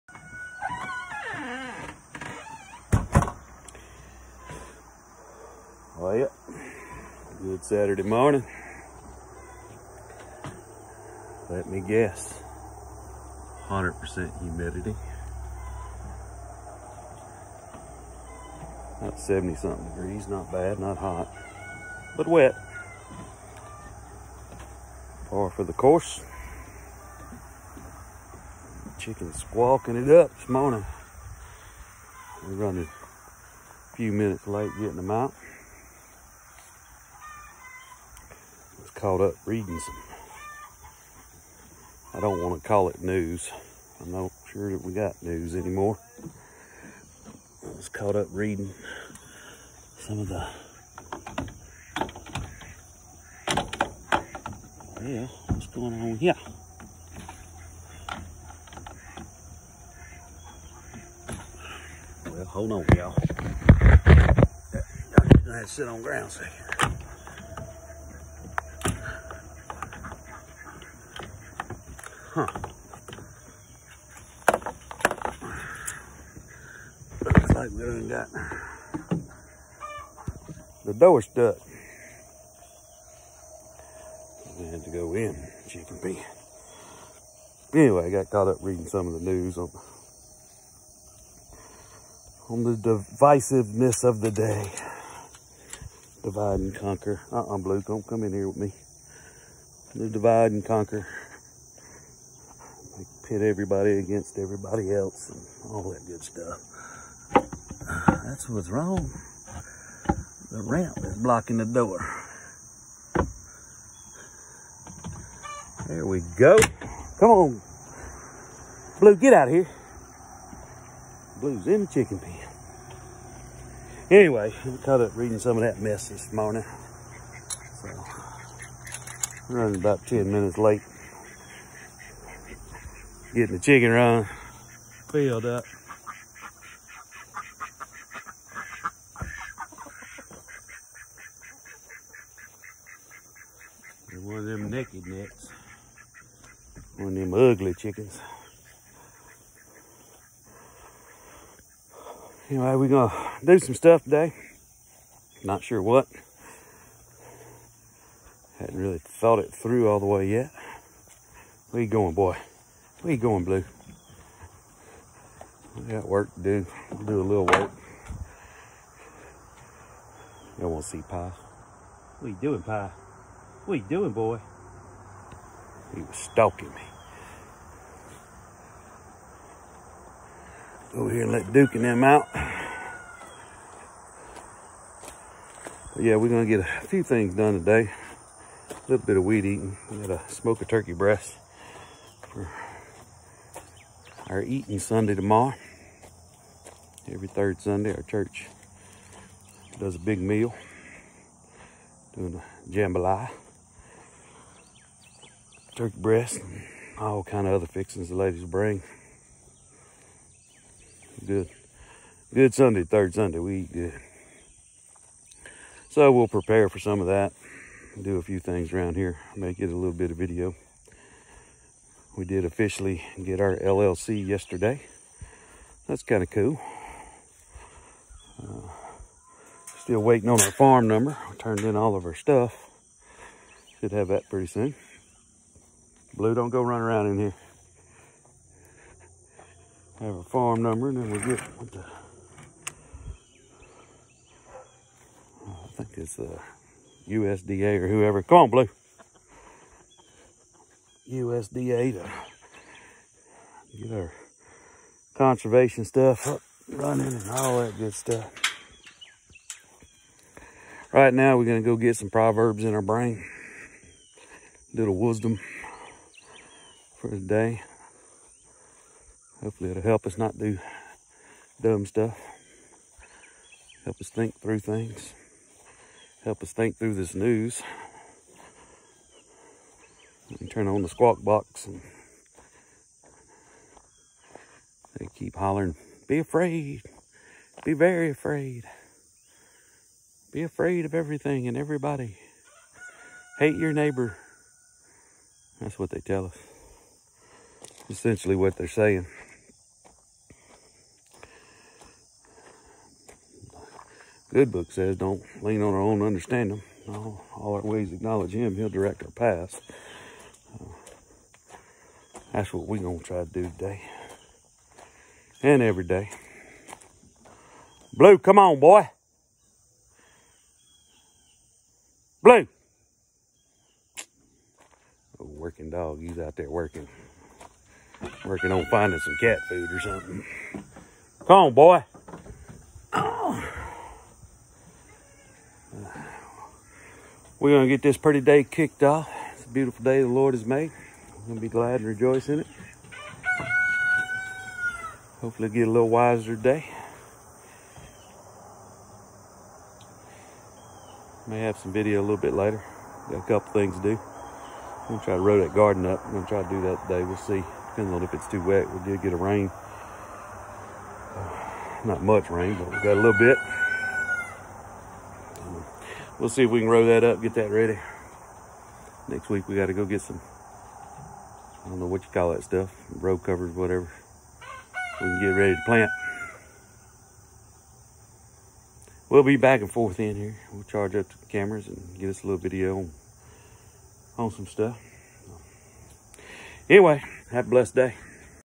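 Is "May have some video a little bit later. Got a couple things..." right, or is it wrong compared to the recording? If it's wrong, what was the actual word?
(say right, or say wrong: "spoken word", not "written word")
right.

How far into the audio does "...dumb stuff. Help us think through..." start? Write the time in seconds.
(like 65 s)
271 s.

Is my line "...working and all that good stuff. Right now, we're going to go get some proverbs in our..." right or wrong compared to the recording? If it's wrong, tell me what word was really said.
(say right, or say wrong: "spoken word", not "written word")
wrong: "running", not "working".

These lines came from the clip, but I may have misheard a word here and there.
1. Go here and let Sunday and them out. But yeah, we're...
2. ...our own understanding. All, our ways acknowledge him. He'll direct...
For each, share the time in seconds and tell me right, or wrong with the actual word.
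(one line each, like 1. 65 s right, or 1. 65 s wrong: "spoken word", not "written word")
1. 180 s wrong: "Duke", not "Sunday"
2. 305 s right.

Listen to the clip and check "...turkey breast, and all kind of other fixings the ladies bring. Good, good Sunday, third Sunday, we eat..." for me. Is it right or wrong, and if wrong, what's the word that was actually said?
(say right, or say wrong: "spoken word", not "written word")
right.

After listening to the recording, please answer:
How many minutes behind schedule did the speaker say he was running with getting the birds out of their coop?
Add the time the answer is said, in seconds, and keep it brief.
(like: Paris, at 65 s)
10, at 130 s.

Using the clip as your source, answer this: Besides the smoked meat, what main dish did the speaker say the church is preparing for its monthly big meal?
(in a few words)
Jambalaya.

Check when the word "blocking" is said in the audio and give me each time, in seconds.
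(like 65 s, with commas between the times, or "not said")
111 s.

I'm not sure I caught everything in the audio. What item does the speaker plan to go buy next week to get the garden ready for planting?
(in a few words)
Row covers.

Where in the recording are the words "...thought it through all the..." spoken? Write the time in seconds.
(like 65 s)
158 s.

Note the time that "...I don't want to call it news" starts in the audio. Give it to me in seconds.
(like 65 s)
42 s.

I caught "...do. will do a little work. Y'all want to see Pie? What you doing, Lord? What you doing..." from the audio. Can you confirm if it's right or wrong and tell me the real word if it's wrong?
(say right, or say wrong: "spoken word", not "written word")
wrong: "Pie", not "Lord".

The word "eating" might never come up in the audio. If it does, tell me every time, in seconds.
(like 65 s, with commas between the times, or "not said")
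189 s, 194 s.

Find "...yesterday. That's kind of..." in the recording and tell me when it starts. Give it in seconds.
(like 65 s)
224 s.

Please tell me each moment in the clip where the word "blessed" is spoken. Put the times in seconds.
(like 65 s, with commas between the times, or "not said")
387 s.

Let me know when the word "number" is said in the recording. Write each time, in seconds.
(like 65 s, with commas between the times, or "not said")
230 s, 240 s.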